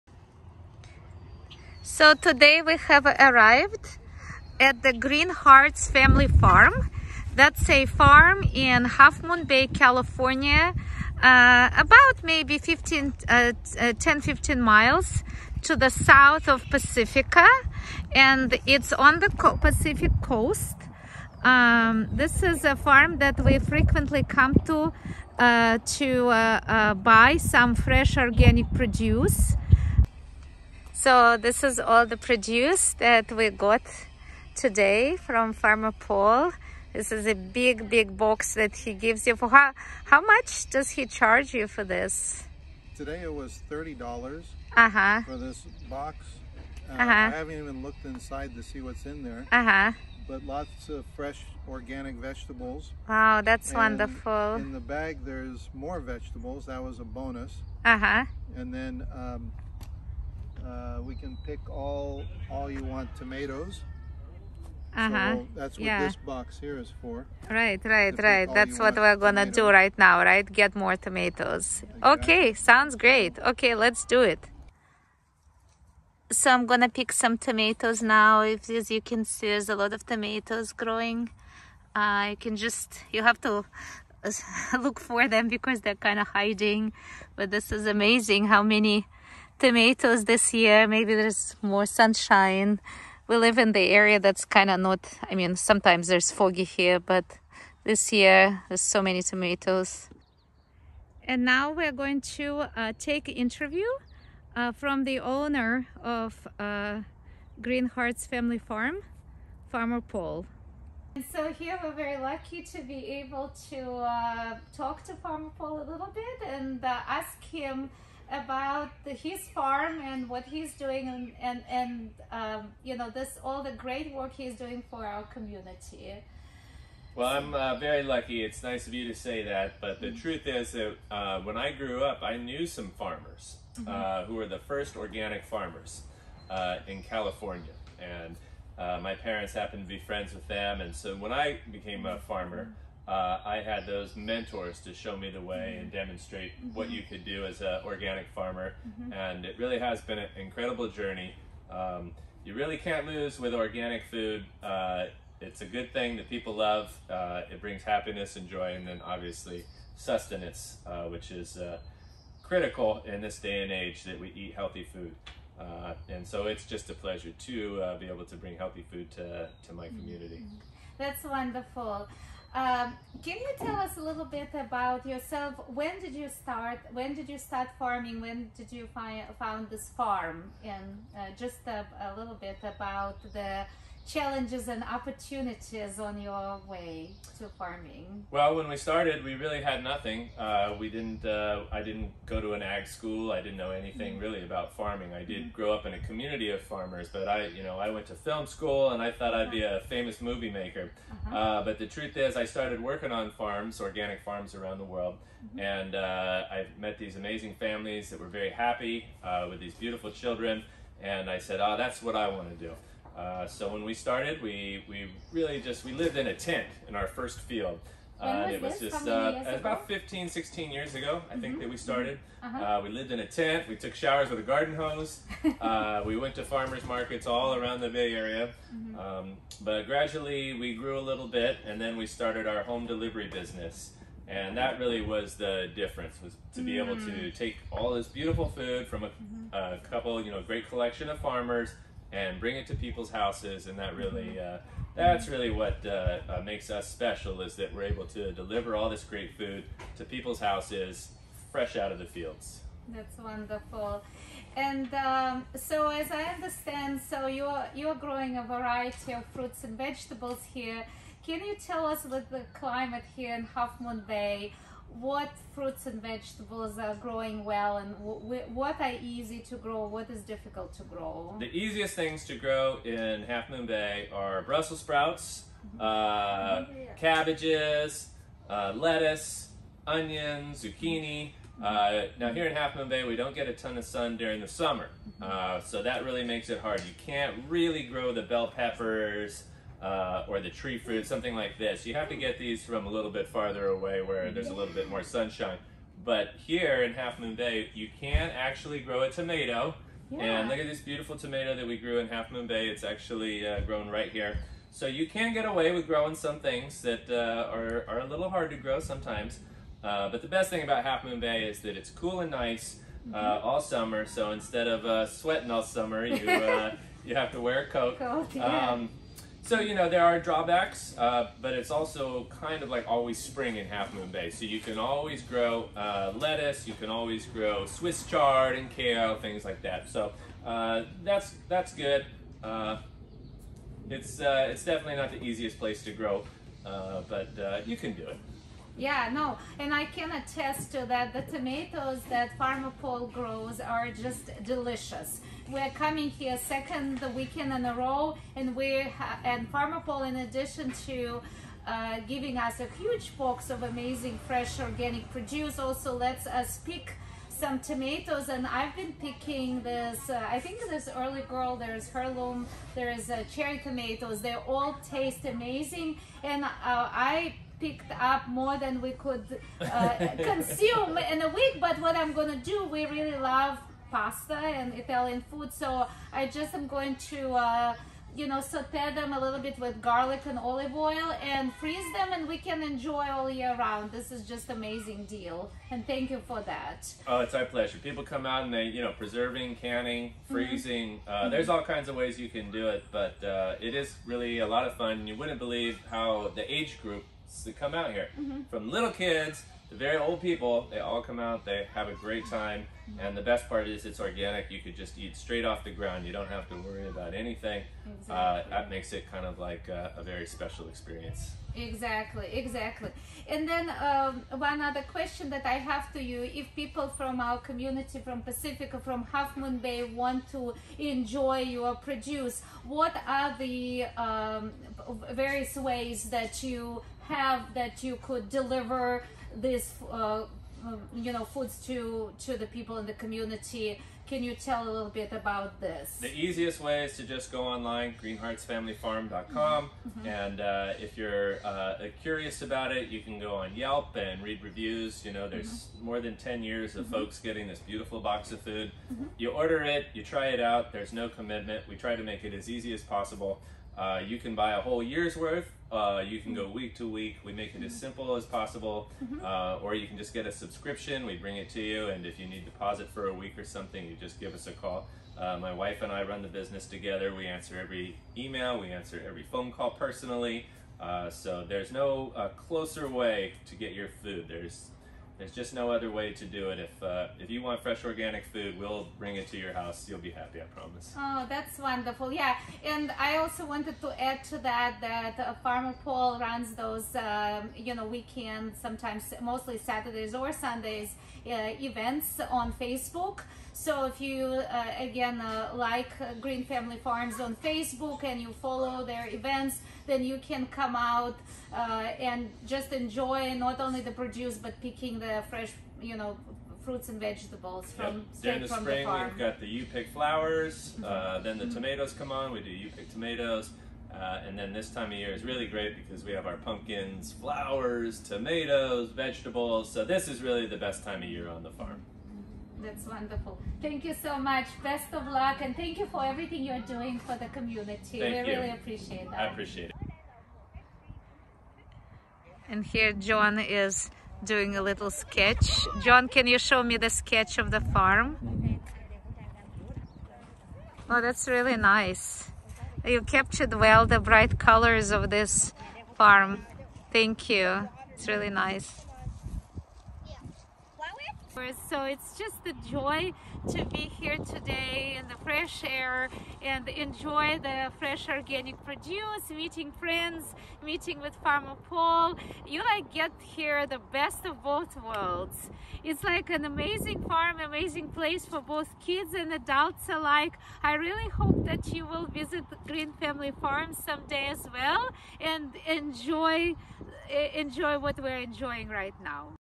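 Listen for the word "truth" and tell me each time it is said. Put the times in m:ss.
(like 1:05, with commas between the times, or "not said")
2:10, 3:21.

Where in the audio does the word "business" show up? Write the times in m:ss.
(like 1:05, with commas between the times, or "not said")
3:53, 7:46.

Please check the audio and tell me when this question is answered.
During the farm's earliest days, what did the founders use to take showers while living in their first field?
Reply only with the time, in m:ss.
3:44.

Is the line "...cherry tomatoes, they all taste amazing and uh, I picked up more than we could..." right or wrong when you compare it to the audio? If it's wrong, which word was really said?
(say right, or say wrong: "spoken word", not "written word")
right.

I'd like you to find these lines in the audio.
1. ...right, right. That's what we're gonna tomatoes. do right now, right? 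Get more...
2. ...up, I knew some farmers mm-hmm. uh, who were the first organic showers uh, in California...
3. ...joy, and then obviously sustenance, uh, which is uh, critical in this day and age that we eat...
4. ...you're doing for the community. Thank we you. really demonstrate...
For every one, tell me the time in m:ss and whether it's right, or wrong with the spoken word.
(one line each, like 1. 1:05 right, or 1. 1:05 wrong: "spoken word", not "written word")
1. 1:07 right
2. 2:12 wrong: "farmers", not "showers"
3. 2:38 right
4. 8:46 wrong: "appreciate", not "demonstrate".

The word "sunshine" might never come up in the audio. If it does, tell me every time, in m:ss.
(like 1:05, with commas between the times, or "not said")
1:31, 4:55.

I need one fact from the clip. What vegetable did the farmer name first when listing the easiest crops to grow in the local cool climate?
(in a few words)
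Brussels sprouts.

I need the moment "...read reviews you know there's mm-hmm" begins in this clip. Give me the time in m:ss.
7:24.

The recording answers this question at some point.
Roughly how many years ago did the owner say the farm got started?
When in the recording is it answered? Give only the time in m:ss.
3:39.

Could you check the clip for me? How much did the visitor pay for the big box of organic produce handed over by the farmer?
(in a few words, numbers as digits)
$30.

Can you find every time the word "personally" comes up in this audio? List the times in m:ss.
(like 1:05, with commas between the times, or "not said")
7:49.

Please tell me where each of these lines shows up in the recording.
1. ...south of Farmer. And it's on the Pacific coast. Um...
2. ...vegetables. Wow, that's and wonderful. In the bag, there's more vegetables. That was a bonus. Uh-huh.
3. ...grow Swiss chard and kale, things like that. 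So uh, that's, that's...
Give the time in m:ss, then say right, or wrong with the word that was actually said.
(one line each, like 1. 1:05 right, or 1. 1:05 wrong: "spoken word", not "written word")
1. 0:15 wrong: "Pacifica", not "Farmer"
2. 0:52 right
3. 5:27 right.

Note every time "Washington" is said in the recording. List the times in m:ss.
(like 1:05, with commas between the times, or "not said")
not said.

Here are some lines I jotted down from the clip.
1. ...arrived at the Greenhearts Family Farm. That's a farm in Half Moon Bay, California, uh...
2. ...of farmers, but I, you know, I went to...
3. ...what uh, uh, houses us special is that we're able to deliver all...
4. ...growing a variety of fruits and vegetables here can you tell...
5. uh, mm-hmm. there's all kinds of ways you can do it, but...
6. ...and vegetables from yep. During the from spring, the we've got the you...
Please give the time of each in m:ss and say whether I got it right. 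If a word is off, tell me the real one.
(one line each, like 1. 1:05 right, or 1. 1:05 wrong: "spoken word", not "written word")
1. 0:03 right
2. 3:16 right
3. 4:05 wrong: "makes", not "houses"
4. 4:17 right
5. 6:31 right
6. 8:26 right.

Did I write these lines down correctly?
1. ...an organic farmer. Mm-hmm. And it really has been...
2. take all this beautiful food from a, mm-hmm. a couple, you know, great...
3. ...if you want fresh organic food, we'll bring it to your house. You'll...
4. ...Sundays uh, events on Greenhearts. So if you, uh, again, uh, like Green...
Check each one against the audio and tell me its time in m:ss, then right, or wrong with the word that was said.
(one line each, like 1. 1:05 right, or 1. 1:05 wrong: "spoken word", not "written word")
1. 2:27 right
2. 3:57 right
3. 7:57 right
4. 8:10 wrong: "Facebook", not "Greenhearts".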